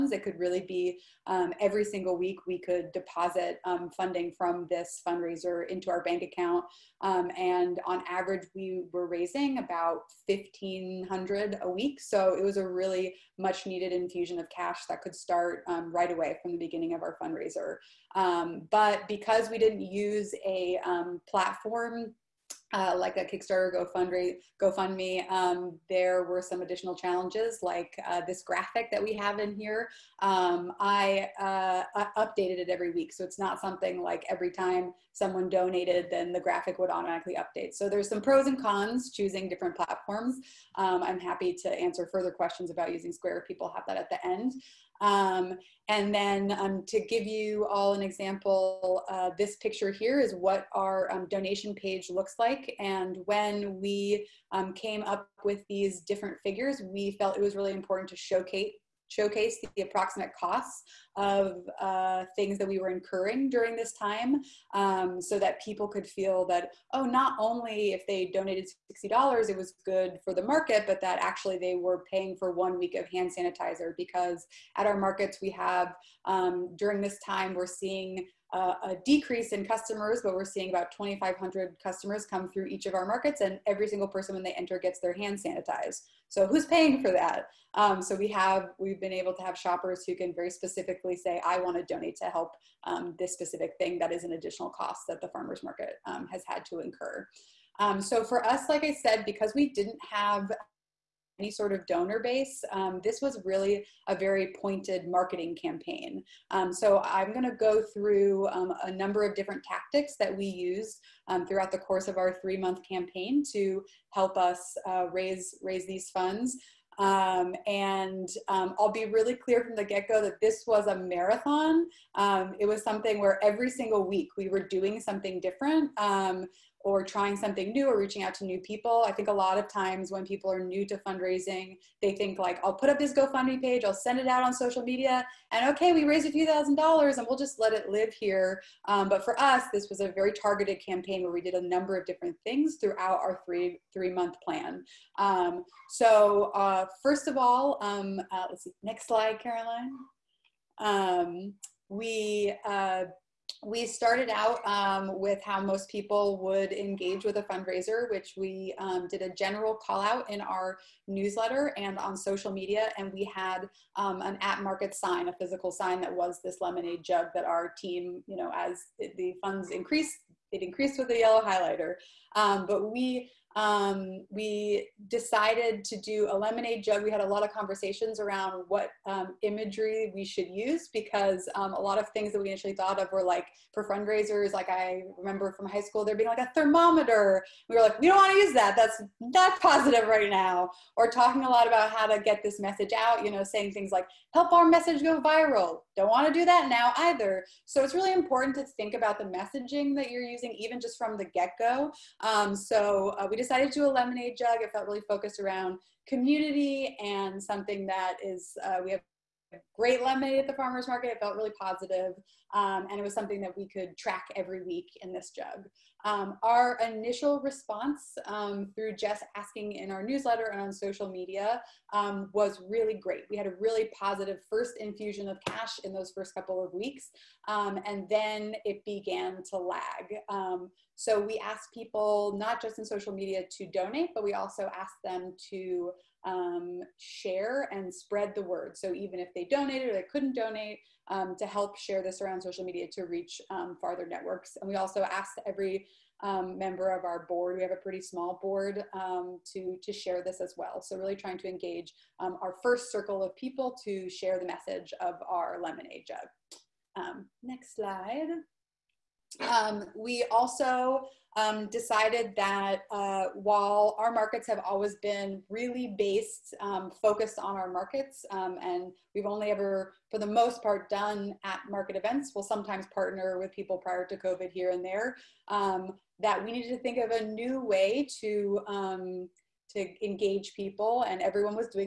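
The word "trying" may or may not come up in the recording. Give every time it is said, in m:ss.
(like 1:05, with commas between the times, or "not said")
2:07, 4:11.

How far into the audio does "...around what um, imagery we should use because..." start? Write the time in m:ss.
2:58.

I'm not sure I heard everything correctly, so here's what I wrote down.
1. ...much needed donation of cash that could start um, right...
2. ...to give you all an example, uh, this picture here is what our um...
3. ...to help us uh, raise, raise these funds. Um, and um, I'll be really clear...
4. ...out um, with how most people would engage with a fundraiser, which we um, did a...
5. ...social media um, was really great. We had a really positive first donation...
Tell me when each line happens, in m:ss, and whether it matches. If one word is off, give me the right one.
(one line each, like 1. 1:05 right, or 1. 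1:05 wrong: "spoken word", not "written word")
1. 0:13 wrong: "infusion", not "donation"
2. 0:46 right
3. 1:53 right
4. 2:34 right
5. 3:40 wrong: "infusion", not "donation".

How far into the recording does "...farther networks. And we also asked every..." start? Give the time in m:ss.
4:03.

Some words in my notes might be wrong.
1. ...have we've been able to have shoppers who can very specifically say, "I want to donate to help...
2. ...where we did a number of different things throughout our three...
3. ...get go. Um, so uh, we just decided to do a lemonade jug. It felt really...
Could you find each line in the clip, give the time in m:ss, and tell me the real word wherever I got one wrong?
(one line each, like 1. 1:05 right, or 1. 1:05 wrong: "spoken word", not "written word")
1. 1:28 right
2. 2:21 right
3. 3:21 right.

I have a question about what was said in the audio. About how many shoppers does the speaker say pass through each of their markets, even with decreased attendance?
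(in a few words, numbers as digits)
2,500.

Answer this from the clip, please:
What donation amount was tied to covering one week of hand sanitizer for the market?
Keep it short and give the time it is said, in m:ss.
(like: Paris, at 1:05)
$60, at 1:09.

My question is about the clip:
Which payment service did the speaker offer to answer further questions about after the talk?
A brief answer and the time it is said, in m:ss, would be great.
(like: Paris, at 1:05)
Square, at 0:43.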